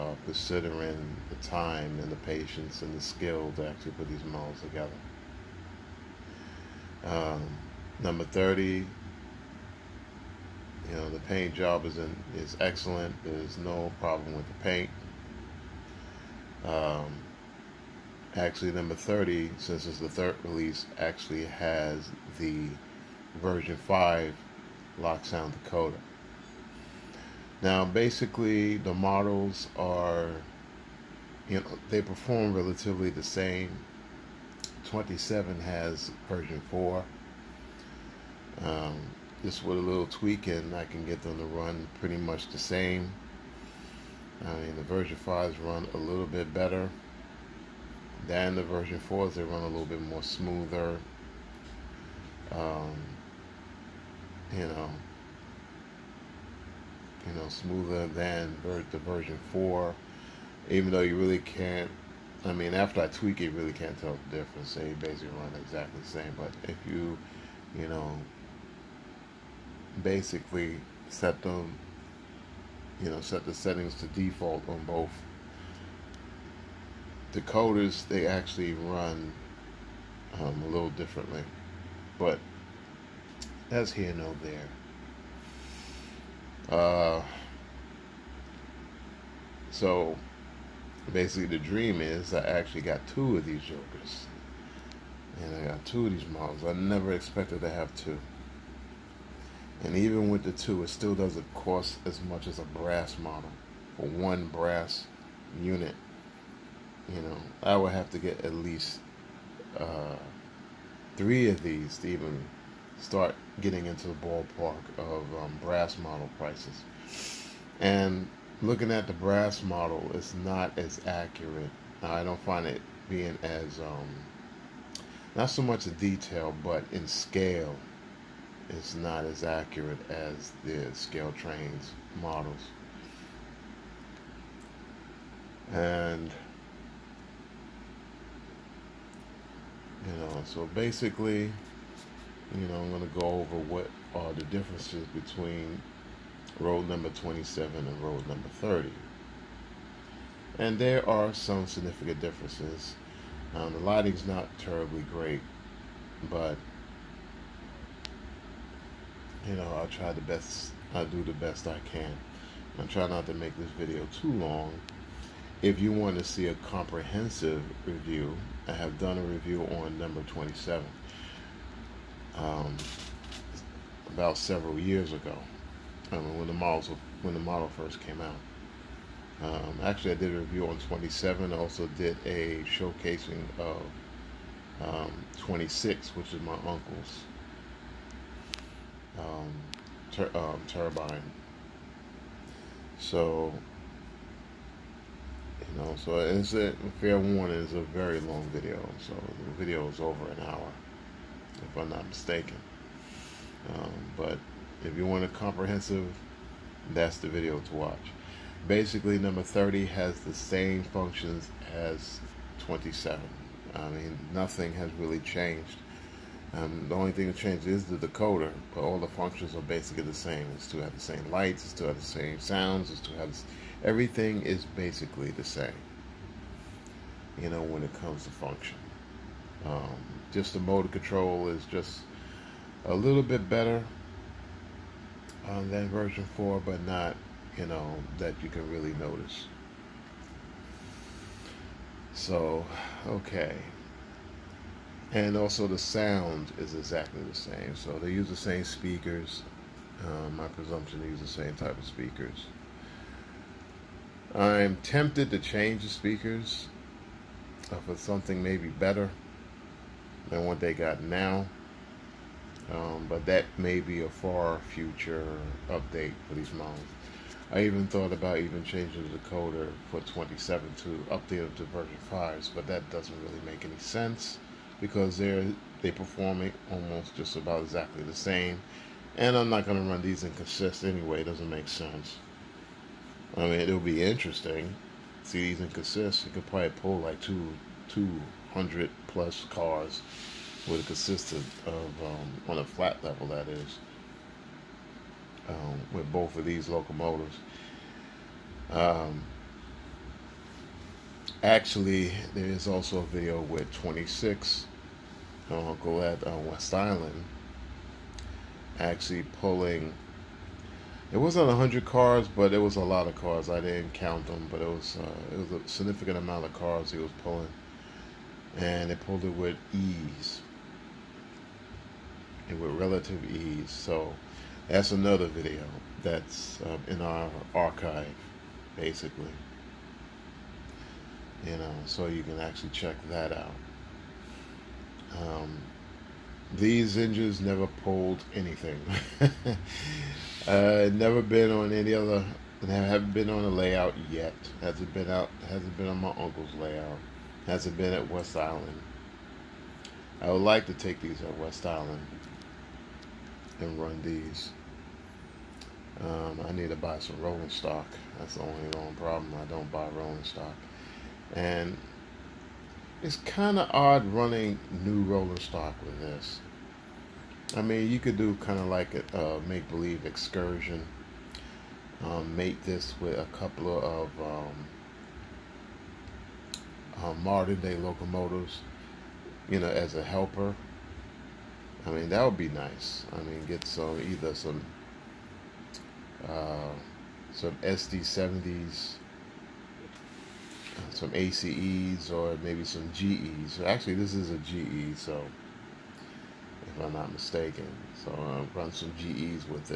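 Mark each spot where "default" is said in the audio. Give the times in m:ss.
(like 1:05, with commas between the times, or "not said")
1:14.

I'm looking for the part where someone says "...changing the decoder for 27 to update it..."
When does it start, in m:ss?
4:28.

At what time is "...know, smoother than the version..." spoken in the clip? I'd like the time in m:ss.
0:57.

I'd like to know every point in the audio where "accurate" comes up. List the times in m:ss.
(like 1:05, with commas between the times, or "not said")
2:01, 2:09.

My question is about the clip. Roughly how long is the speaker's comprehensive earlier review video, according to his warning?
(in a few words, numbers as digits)
over an hour.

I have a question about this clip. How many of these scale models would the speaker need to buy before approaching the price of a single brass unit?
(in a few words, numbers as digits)
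3.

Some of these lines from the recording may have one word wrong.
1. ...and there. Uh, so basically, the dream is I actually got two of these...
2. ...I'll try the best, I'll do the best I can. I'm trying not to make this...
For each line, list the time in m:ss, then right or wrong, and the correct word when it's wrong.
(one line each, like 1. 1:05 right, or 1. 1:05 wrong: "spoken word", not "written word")
1. 1:24 right
2. 2:39 right.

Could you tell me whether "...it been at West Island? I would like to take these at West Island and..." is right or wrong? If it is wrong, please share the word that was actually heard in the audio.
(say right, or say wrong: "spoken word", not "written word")
right.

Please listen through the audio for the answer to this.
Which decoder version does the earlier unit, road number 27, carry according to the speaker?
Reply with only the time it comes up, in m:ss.
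0:34.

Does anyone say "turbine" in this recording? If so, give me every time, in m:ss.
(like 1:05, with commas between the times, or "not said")
3:10.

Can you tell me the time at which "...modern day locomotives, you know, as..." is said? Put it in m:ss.
6:17.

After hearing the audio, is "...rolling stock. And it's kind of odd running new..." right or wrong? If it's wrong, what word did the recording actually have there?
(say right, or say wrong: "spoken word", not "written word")
right.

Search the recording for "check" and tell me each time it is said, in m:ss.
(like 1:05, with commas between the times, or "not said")
5:32.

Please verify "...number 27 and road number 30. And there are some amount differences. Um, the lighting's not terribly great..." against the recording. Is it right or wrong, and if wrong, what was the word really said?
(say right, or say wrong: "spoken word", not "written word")
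wrong: "significant", not "amount".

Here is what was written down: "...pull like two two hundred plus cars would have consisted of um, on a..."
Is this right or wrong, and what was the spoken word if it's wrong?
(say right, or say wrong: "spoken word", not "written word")
right.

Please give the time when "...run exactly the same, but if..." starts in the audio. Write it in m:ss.
1:05.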